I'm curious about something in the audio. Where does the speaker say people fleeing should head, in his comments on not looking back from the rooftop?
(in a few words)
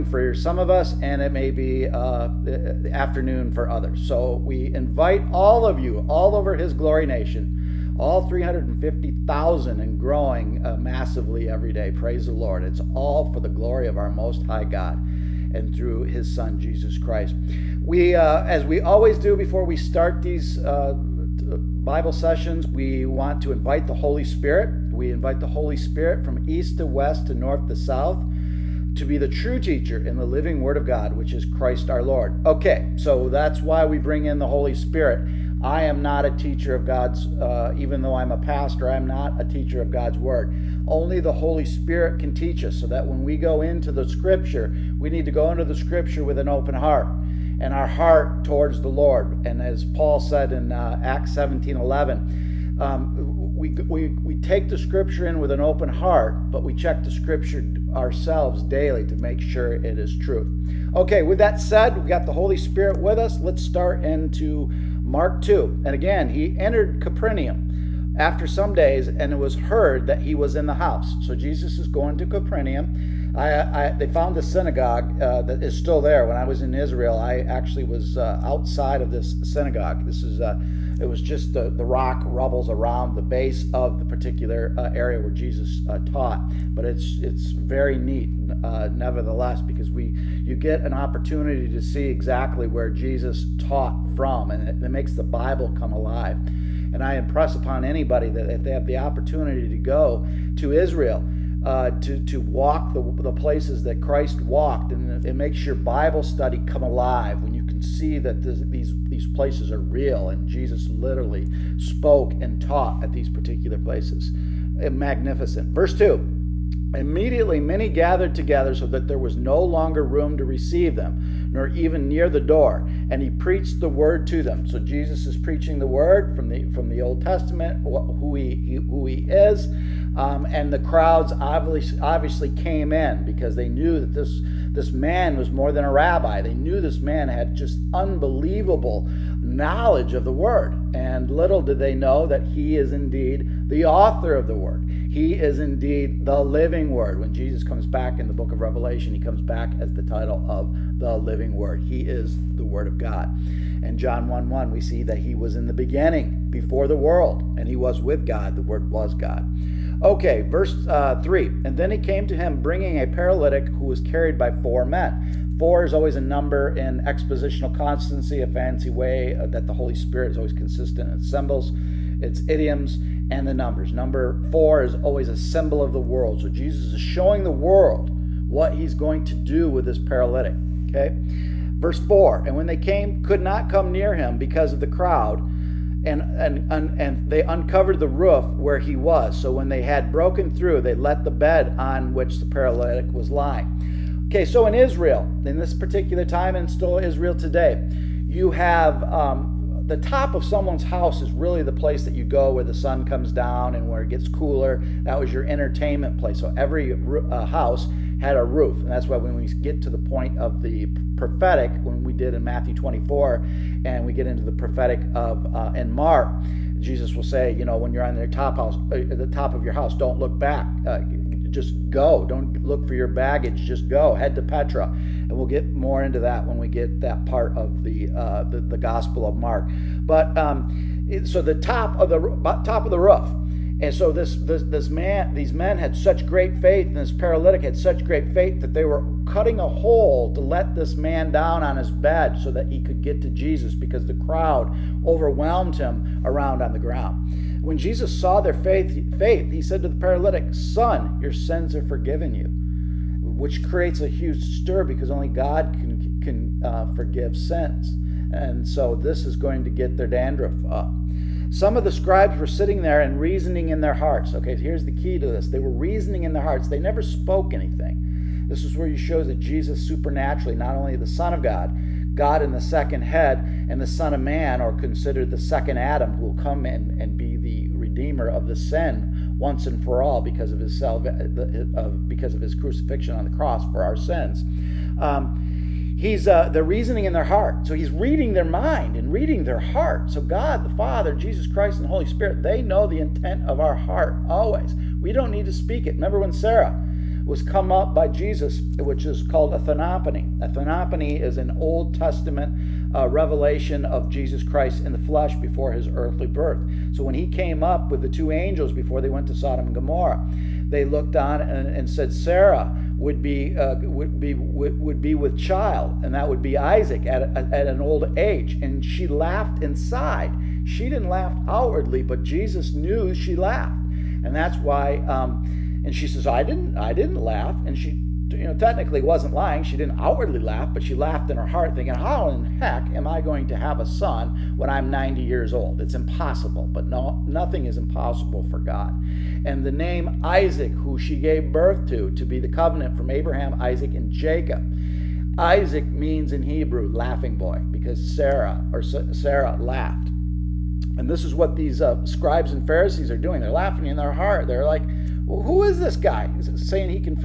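Petra.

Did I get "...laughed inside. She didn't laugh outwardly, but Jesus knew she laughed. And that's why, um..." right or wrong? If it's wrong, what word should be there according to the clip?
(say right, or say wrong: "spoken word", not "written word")
right.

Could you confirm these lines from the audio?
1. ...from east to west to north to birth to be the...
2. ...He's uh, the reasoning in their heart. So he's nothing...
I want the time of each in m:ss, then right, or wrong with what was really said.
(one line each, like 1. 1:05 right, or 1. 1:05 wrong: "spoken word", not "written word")
1. 0:26 wrong: "south", not "birth"
2. 4:45 wrong: "reading", not "nothing".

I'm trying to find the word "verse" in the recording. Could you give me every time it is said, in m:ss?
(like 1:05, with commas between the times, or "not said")
1:55, 2:40, 3:01.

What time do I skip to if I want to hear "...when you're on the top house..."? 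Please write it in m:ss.
3:37.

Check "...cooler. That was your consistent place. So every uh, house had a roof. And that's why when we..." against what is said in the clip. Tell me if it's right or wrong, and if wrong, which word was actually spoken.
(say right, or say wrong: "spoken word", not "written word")
wrong: "entertainment", not "consistent".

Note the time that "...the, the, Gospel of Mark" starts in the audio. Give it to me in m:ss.
3:48.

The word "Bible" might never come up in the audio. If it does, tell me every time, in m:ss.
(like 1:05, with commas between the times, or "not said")
0:21, 1:35, 1:45.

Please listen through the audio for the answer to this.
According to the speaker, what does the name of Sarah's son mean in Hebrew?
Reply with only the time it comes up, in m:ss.
5:46.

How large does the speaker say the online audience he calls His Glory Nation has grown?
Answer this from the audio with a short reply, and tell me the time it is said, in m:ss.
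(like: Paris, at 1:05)
350,000, at 0:08.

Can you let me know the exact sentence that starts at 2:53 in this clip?
Number four is always a symbol of the world.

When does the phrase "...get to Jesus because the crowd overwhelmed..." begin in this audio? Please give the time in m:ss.
4:03.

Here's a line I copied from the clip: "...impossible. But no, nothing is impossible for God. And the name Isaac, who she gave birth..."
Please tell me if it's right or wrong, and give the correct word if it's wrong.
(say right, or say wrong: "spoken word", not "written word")
right.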